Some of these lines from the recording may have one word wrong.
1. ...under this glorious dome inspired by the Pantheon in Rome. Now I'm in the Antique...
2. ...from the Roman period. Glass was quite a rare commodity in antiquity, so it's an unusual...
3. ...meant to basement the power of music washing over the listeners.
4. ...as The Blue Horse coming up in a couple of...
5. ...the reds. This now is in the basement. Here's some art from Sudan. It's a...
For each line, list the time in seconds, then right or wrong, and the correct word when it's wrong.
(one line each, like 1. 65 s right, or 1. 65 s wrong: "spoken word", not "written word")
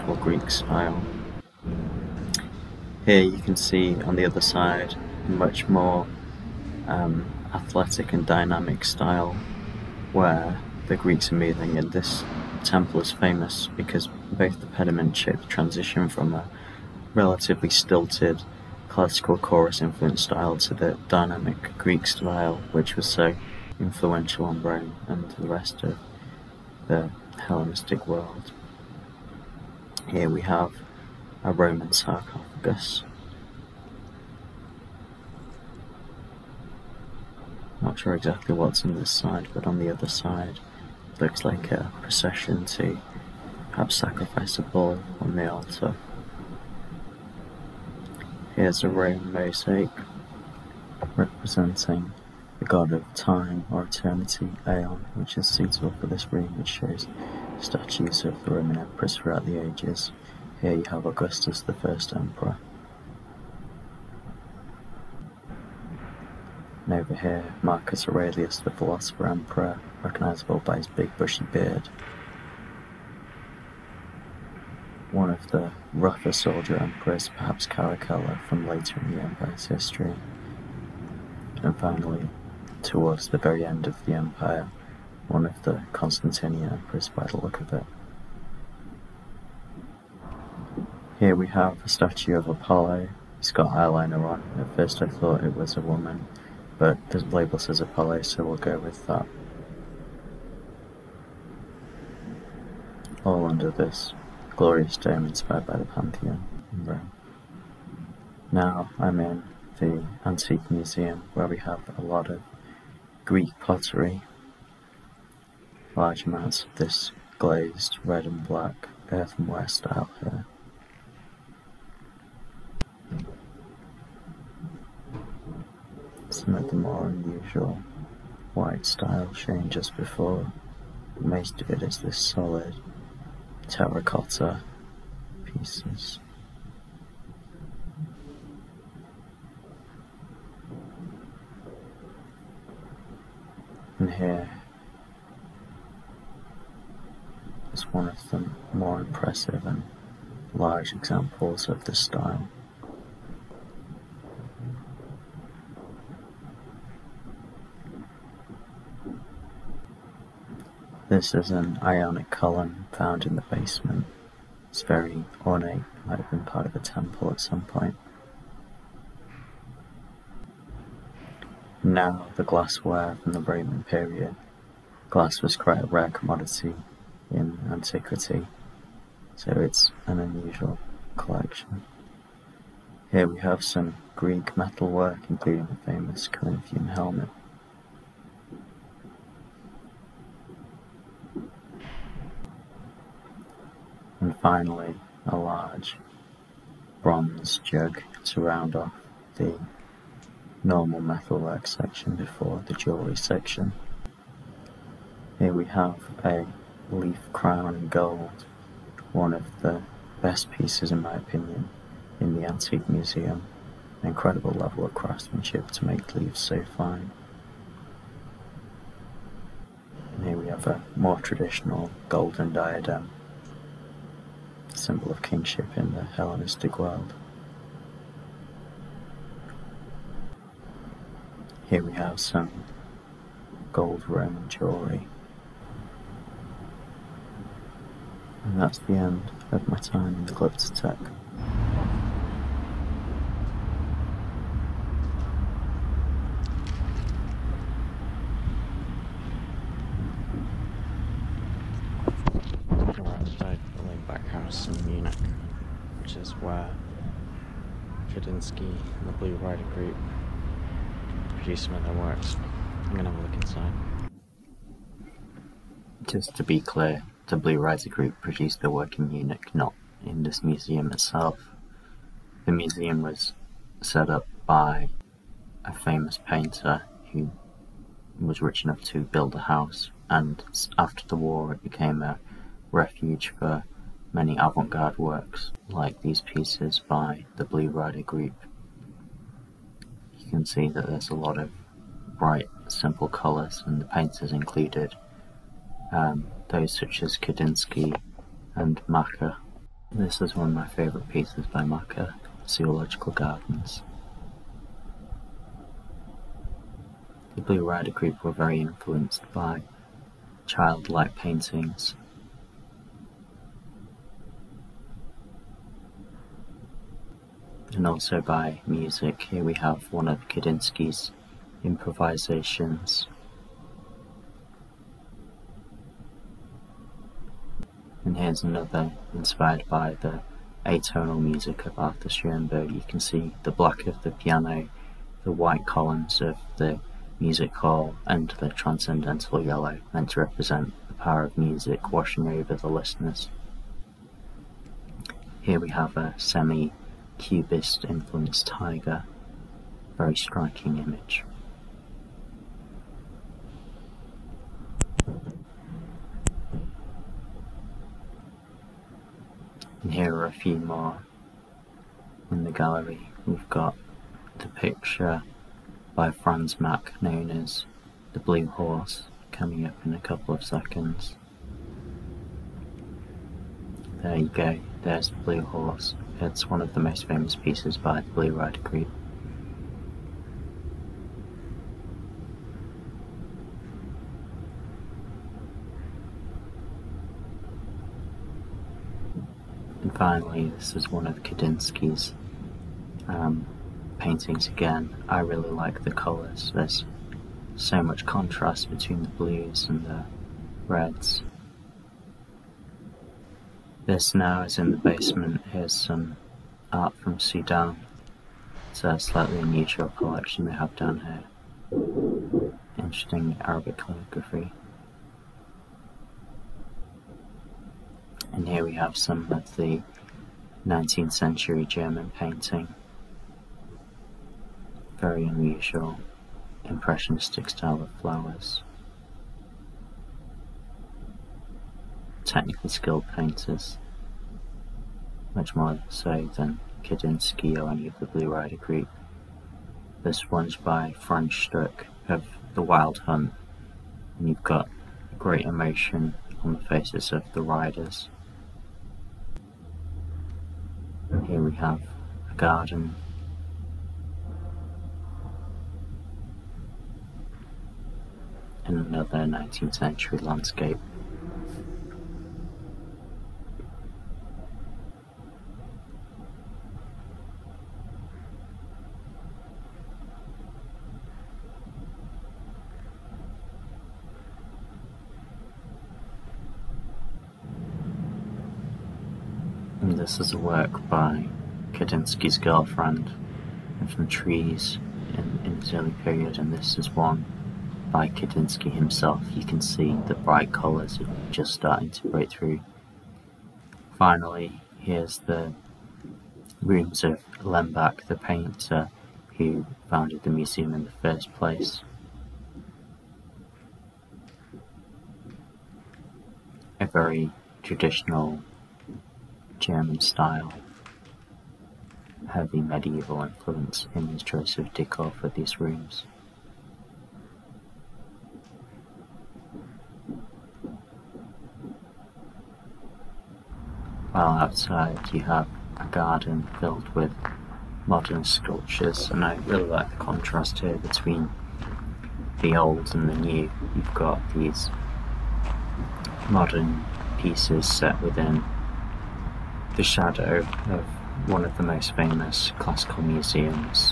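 1. 103 s right
2. 173 s right
3. 339 s wrong: "represent", not "basement"
4. 367 s right
5. 399 s right.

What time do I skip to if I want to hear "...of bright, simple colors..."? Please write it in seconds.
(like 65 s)
291 s.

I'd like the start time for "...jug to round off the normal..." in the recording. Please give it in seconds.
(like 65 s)
197 s.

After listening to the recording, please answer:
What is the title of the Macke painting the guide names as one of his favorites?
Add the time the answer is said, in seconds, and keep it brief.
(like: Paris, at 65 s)
Zoological Gardens, at 302 s.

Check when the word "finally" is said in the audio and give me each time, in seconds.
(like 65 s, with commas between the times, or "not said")
81 s, 194 s, 389 s, 493 s.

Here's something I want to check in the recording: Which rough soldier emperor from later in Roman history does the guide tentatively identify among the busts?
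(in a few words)
Caracalla.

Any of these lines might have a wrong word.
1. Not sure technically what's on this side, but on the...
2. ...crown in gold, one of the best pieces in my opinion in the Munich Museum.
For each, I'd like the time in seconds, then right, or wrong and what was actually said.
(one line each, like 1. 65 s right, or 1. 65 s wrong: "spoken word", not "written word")
1. 37 s wrong: "exactly", not "technically"
2. 207 s wrong: "Antique", not "Munich".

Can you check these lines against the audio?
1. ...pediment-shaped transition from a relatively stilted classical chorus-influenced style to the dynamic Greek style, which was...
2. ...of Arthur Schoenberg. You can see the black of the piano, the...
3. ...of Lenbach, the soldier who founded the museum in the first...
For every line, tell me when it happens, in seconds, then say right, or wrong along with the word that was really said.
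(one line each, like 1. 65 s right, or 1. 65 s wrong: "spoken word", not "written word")
1. 14 s right
2. 331 s right
3. 497 s wrong: "painter", not "soldier".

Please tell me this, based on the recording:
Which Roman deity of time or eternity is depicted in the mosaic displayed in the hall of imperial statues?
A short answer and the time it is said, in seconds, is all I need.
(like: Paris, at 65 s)
Aeon, at 54 s.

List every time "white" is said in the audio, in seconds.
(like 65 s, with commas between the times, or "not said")
128 s, 335 s.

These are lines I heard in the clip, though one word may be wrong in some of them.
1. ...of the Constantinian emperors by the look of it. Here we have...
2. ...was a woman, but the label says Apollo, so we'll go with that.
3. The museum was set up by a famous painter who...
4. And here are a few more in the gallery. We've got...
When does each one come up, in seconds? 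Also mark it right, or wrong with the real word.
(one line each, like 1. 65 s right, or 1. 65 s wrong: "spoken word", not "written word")
1. 85 s right
2. 95 s right
3. 272 s right
4. 359 s right.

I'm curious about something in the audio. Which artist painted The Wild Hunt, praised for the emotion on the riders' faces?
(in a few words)
Franz Stuck.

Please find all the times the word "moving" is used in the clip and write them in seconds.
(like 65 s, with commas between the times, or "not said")
11 s.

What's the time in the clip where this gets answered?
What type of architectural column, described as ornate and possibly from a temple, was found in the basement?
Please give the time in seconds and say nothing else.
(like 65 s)
161 s.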